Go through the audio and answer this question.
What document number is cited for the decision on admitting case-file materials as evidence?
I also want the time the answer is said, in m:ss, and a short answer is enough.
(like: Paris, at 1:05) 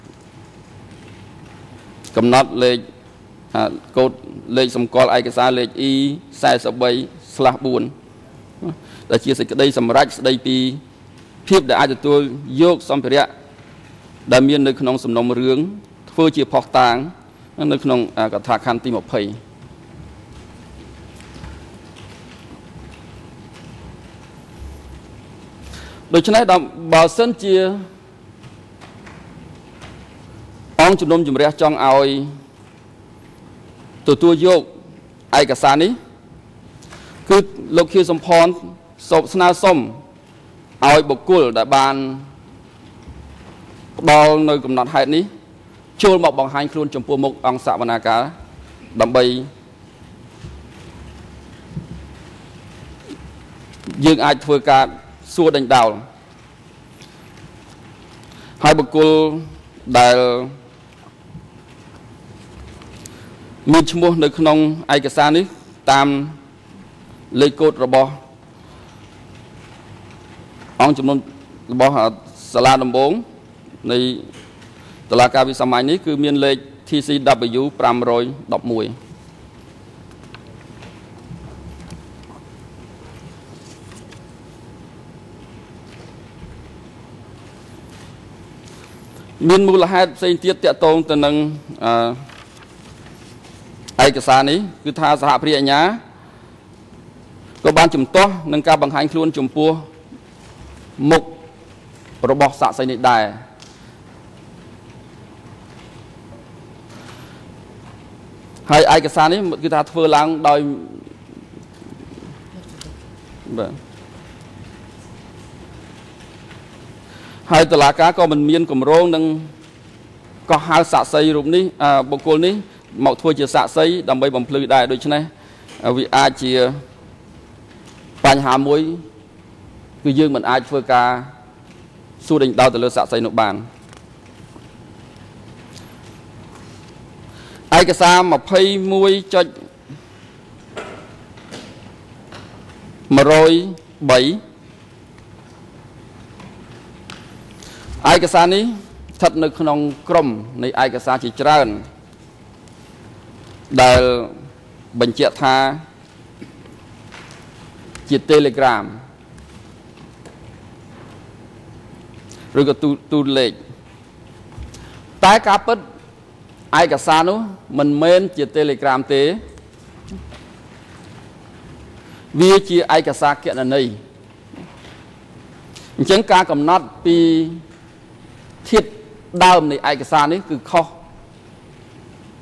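E43/4, at 0:05.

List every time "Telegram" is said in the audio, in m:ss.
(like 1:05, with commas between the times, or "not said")
2:38, 2:48.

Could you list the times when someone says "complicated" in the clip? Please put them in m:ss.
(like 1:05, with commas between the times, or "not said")
not said.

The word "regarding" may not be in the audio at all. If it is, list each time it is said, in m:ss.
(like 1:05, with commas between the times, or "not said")
not said.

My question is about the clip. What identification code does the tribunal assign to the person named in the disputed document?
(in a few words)
TCW 511.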